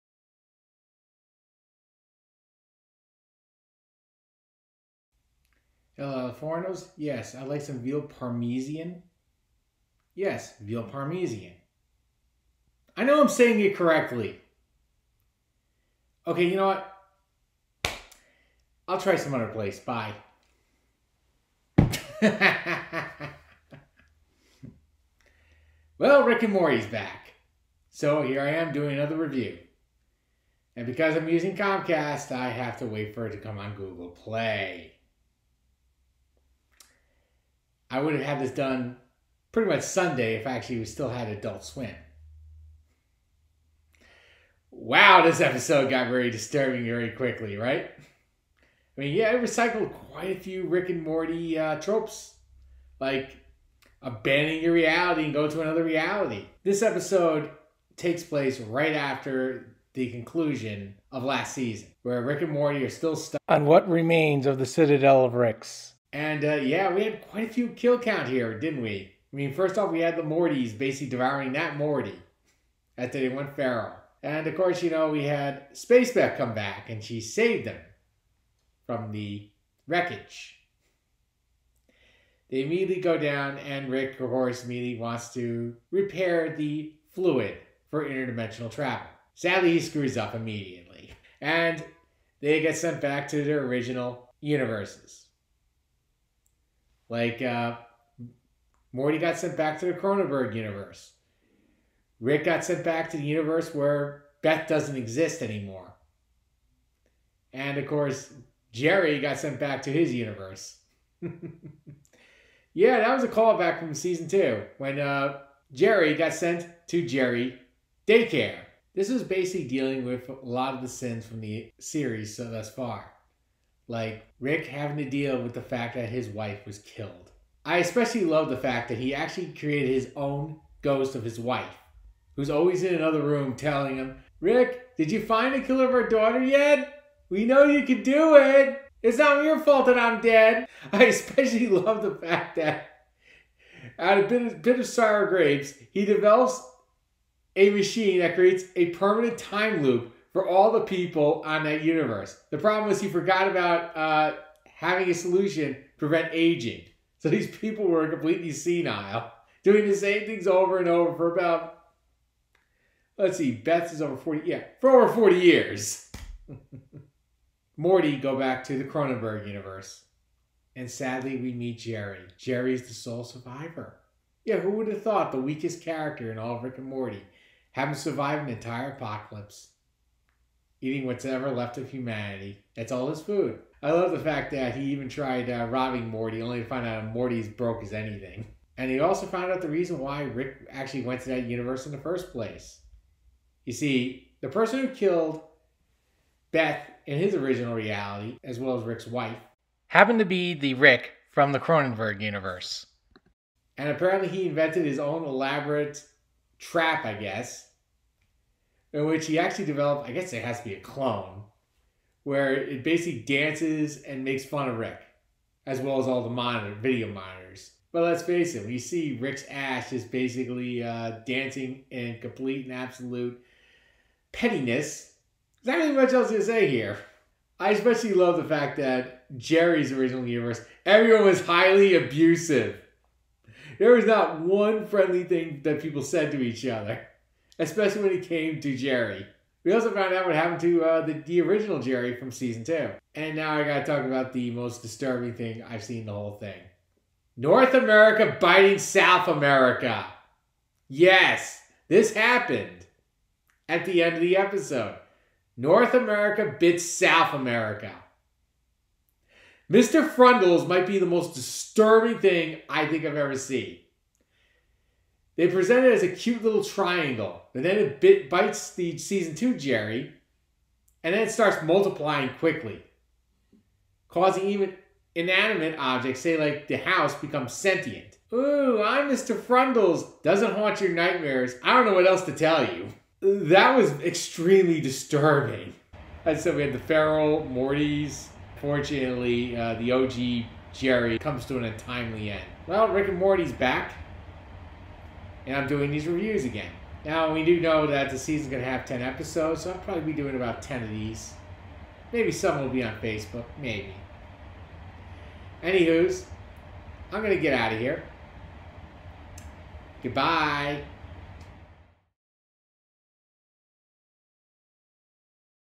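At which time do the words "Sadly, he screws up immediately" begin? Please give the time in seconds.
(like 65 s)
89 s.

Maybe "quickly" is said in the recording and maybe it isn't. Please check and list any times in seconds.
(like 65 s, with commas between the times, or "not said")
47 s, 272 s.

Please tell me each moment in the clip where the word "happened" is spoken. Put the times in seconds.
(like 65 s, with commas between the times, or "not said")
199 s, 240 s, 252 s.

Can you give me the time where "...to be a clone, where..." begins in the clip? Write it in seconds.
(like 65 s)
210 s.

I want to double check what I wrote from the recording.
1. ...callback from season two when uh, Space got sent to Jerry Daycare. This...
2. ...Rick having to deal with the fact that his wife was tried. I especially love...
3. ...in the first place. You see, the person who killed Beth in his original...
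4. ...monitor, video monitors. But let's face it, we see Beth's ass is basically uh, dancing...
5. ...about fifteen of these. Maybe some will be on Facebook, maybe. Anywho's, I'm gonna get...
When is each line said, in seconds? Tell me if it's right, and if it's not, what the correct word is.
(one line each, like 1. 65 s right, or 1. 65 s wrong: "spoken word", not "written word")
1. 113 s wrong: "Jerry", not "Space"
2. 124 s wrong: "killed", not "tried"
3. 191 s right
4. 216 s wrong: "Rick", not "Beth"
5. 300 s wrong: "ten", not "fifteen".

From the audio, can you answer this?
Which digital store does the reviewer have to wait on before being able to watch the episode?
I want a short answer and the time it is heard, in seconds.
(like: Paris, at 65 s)
Google Play, at 33 s.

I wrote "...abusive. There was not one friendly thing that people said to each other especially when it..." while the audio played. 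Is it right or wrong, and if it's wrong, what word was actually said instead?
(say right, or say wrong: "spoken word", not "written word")
right.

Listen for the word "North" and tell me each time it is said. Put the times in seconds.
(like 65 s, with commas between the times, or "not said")
247 s, 255 s.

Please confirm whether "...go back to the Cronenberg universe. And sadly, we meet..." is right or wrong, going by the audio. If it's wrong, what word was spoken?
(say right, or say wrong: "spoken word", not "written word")
right.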